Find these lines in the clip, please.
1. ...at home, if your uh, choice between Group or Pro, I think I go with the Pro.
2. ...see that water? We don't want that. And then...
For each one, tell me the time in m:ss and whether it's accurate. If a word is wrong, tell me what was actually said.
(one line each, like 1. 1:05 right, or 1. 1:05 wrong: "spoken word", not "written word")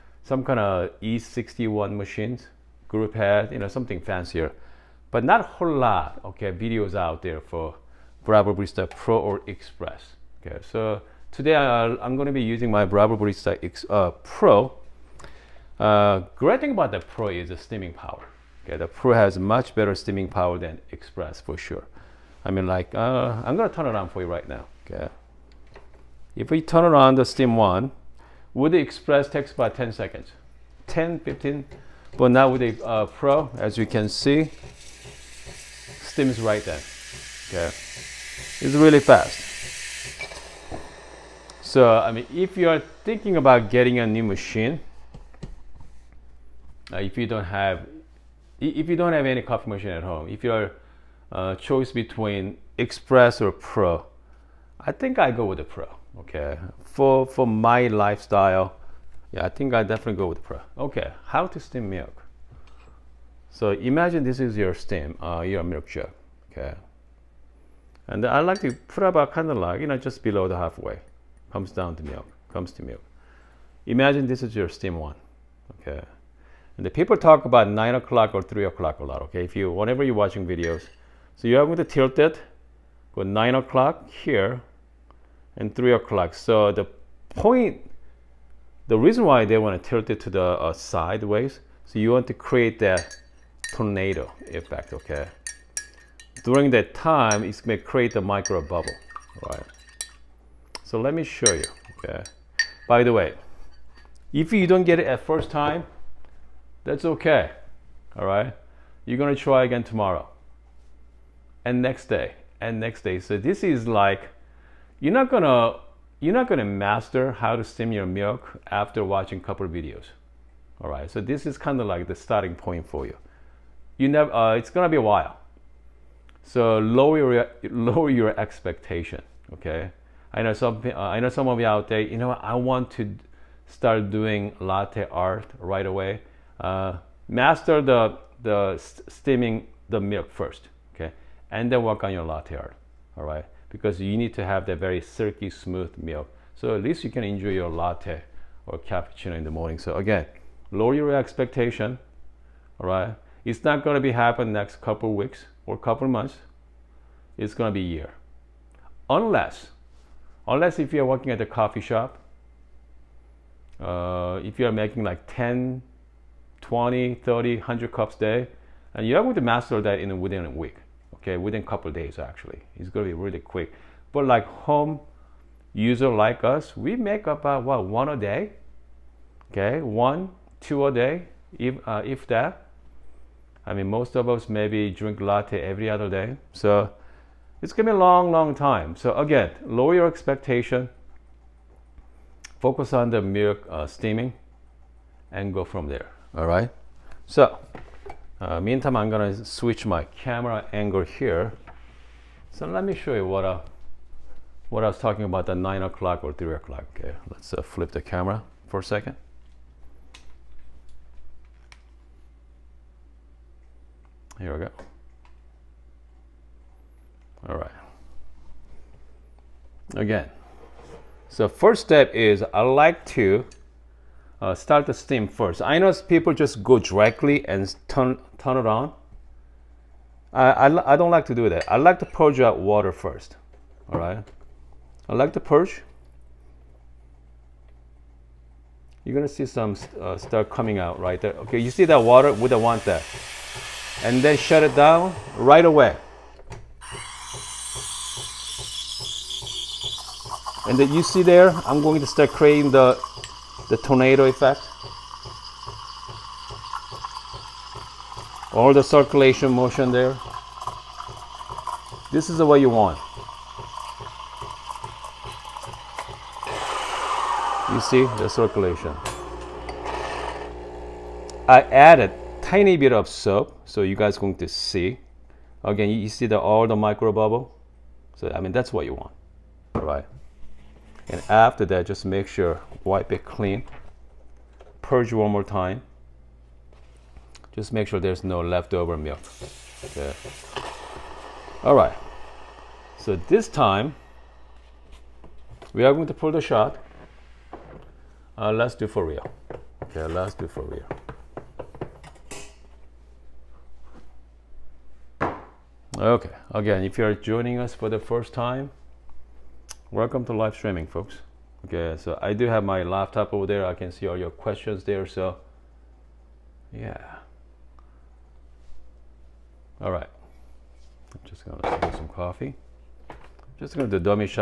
1. 0:49 wrong: "Express", not "Group"
2. 4:01 right.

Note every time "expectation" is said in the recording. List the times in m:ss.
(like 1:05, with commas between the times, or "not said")
2:08, 2:31, 3:10.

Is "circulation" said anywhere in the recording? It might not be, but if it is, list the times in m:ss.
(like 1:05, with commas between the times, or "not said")
4:18, 4:28.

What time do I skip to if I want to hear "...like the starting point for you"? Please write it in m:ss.
2:01.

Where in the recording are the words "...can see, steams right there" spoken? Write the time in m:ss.
0:33.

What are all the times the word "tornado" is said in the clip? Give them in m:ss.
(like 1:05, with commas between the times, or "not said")
1:33, 4:13.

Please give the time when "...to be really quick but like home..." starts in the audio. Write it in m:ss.
2:53.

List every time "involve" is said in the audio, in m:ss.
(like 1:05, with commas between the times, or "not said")
not said.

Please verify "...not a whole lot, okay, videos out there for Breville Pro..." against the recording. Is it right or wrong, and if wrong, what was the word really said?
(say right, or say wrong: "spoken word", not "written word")
wrong: "Barista", not "Pro".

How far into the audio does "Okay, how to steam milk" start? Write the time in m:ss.
1:00.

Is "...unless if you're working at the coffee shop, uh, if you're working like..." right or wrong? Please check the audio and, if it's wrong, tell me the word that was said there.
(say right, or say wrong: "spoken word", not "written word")
wrong: "making", not "working".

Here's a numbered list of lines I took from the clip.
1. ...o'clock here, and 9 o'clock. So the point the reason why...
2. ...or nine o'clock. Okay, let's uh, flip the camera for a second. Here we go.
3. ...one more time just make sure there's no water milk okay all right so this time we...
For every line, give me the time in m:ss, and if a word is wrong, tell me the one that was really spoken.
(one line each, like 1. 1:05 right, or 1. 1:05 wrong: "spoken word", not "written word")
1. 1:23 wrong: "3", not "9"
2. 3:26 wrong: "three", not "nine"
3. 4:45 wrong: "leftover", not "water".